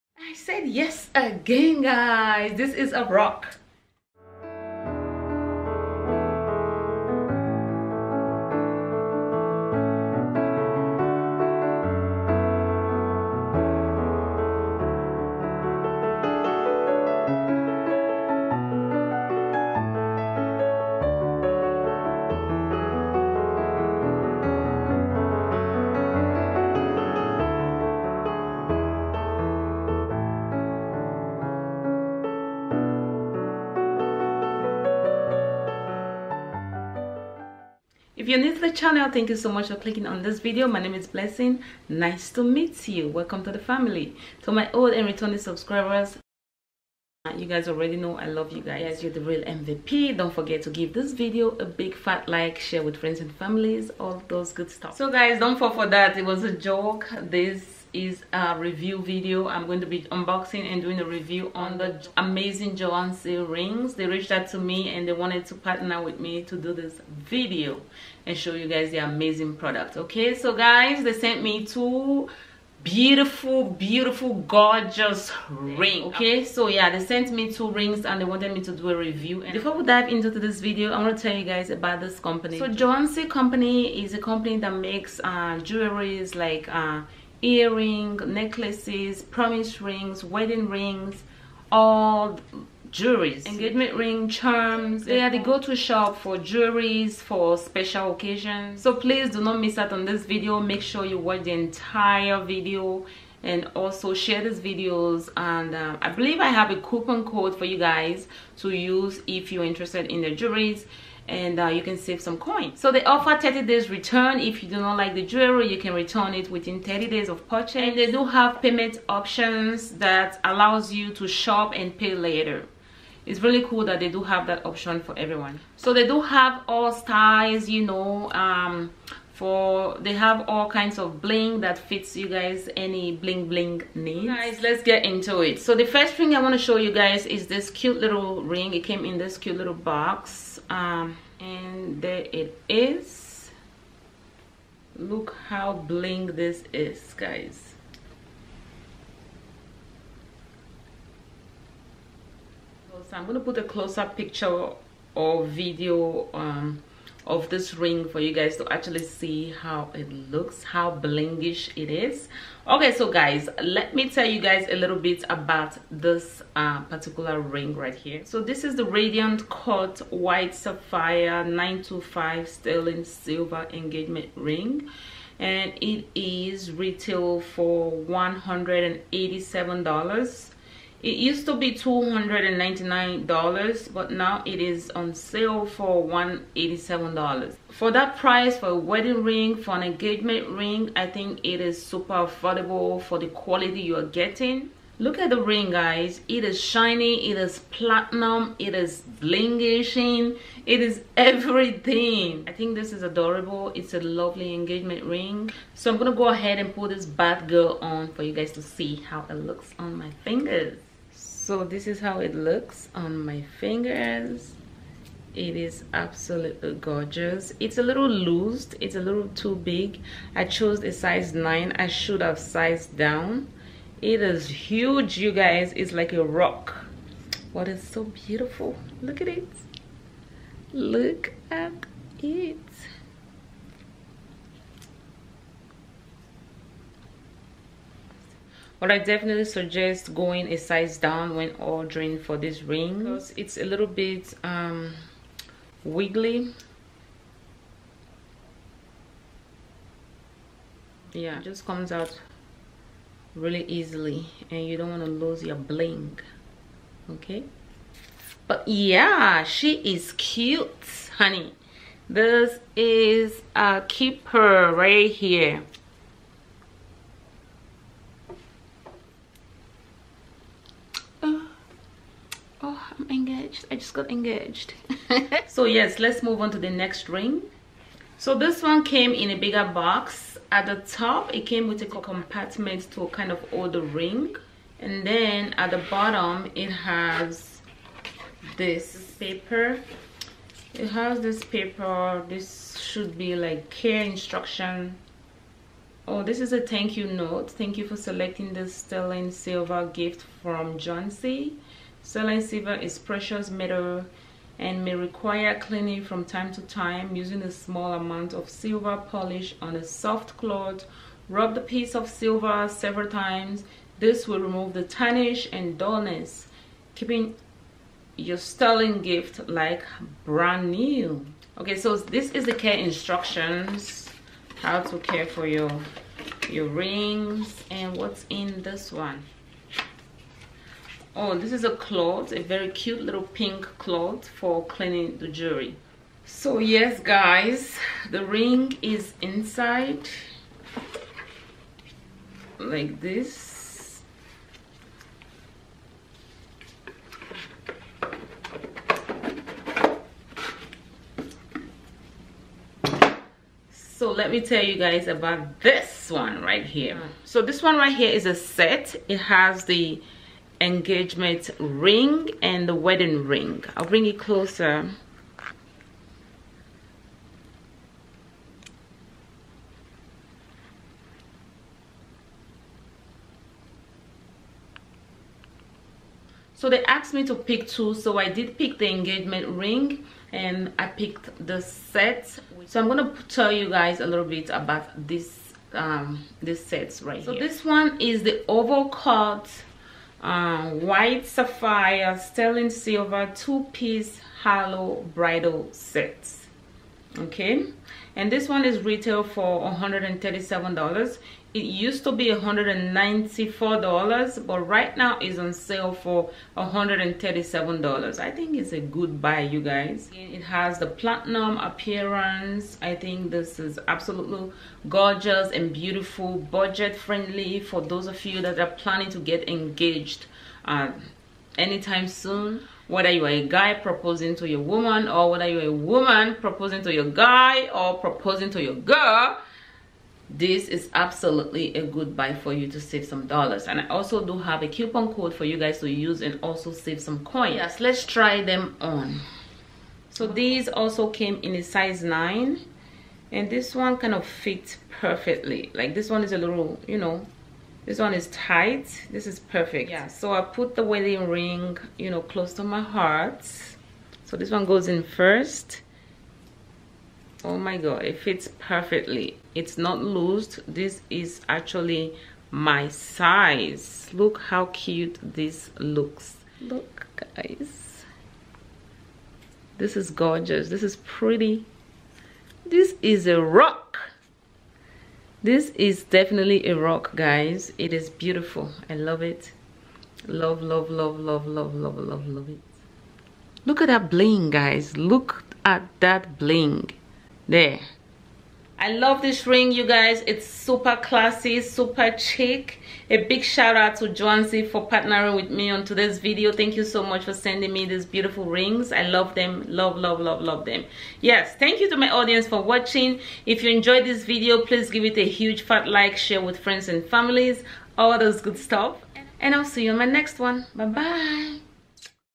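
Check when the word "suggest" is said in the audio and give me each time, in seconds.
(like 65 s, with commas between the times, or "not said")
239 s.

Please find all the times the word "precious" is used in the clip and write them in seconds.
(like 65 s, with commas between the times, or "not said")
302 s.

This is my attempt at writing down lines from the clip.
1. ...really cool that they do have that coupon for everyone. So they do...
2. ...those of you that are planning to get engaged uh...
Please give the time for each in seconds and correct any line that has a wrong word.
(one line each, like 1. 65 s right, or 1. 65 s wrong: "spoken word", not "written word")
1. 123 s wrong: "option", not "coupon"
2. 417 s right.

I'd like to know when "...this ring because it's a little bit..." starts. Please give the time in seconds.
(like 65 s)
242 s.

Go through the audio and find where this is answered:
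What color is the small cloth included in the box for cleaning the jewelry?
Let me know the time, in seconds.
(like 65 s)
333 s.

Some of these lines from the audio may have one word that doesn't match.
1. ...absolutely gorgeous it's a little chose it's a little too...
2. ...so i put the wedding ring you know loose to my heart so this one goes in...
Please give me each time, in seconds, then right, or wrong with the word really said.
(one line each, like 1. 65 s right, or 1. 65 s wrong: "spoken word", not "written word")
1. 215 s wrong: "loose", not "chose"
2. 450 s wrong: "close", not "loose".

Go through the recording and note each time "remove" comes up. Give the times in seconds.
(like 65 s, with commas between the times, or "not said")
314 s.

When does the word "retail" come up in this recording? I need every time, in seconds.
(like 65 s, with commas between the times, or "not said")
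176 s, 398 s.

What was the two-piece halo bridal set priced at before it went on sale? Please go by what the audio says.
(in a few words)
$194.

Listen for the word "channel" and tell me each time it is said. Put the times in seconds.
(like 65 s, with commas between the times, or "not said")
38 s.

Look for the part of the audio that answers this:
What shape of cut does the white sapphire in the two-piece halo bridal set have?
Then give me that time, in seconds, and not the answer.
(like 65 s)
388 s.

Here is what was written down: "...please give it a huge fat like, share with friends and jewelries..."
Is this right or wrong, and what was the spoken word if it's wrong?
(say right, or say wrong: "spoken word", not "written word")
wrong: "families", not "jewelries".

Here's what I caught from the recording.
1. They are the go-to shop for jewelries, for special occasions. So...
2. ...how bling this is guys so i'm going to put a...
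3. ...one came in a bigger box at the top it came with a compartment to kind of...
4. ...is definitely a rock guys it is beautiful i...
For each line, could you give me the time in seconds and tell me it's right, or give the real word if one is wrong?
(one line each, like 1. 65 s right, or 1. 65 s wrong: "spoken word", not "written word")
1. 95 s right
2. 145 s right
3. 278 s right
4. 475 s right.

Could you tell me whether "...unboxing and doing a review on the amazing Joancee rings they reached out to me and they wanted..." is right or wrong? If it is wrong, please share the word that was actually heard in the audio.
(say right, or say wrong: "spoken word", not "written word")
right.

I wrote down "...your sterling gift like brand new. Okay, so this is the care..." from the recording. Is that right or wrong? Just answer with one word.
right.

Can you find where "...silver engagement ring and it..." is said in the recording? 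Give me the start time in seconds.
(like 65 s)
173 s.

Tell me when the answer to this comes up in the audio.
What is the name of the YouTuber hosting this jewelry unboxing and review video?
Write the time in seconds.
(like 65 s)
41 s.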